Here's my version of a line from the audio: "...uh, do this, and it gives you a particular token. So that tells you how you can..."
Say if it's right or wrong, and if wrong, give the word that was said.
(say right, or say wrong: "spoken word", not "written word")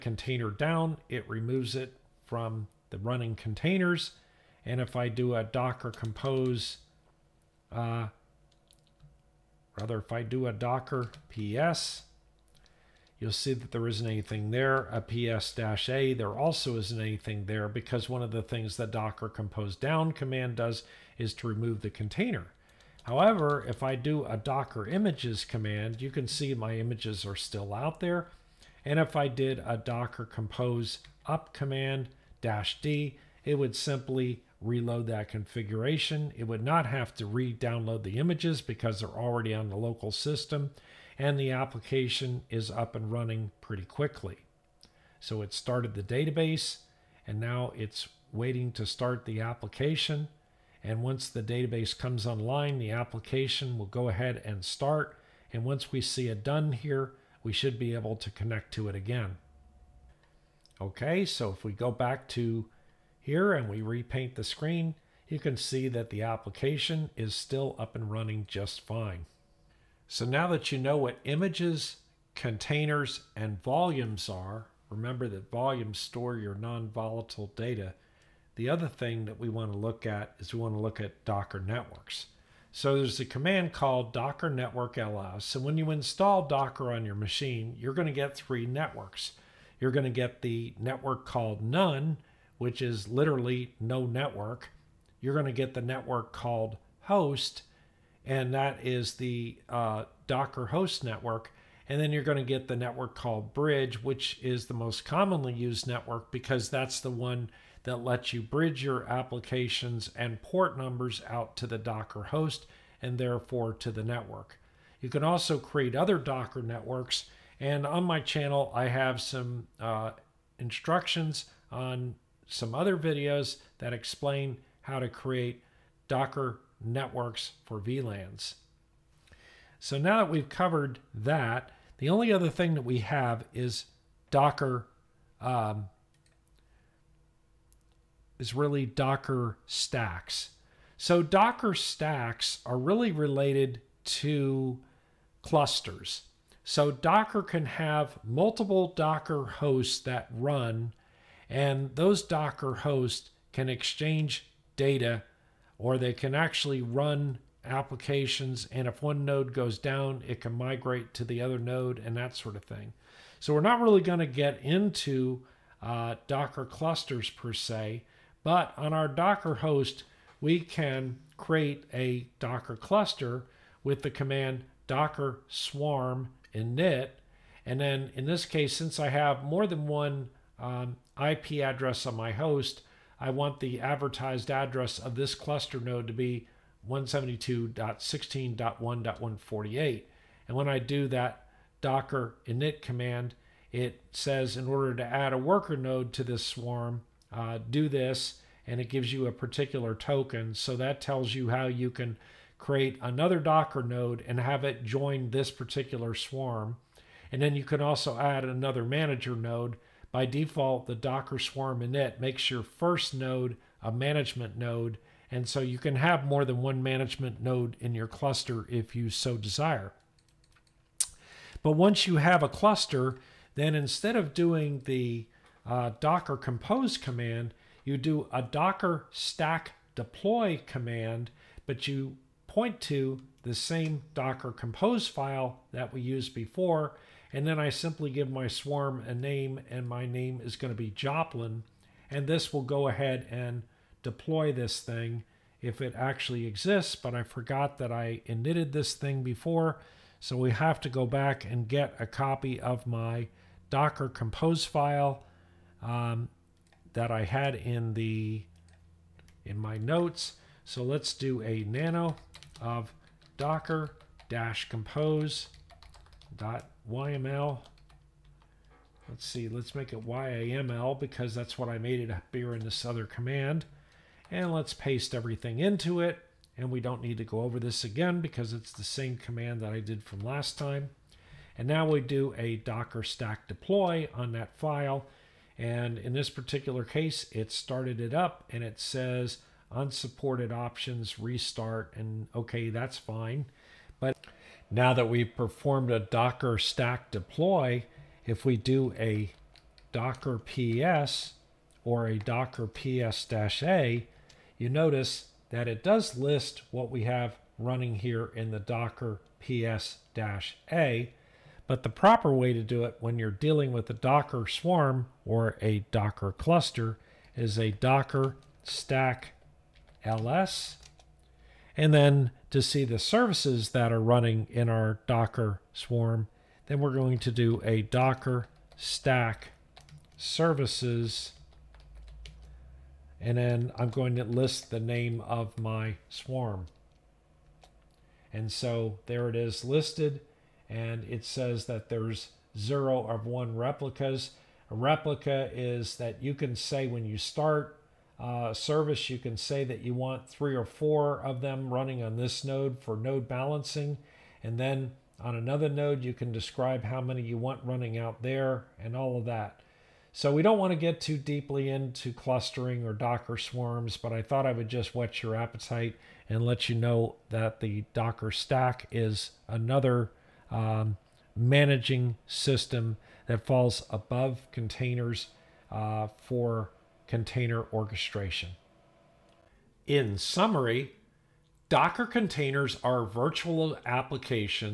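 right.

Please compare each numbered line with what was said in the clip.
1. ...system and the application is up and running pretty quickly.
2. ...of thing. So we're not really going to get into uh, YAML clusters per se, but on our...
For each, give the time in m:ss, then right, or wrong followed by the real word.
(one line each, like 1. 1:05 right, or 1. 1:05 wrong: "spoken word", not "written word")
1. 0:40 right
2. 2:42 wrong: "Docker", not "YAML".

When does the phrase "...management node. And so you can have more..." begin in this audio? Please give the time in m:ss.
3:33.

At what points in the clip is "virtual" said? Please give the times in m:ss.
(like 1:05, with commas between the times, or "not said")
6:23.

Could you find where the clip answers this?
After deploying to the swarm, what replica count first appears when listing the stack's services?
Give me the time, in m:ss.
5:42.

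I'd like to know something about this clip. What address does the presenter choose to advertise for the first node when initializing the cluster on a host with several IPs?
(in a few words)
172.16.1.148.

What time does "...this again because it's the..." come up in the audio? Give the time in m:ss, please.
4:37.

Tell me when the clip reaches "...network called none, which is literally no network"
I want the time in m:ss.
1:30.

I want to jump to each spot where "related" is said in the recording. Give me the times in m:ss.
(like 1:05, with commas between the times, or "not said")
2:23.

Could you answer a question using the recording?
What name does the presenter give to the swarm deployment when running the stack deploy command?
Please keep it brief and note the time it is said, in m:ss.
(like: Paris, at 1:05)
Joplin, at 4:00.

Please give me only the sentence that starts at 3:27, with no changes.
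And then you can also add another manager node.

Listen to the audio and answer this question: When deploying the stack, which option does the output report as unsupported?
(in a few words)
restart.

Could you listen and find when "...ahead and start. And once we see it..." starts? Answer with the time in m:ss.
0:54.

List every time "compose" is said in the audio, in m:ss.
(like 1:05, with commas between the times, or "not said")
0:05, 0:19, 0:30, 3:46, 3:54, 4:14, 4:24.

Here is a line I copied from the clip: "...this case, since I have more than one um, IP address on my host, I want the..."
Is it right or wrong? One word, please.
right.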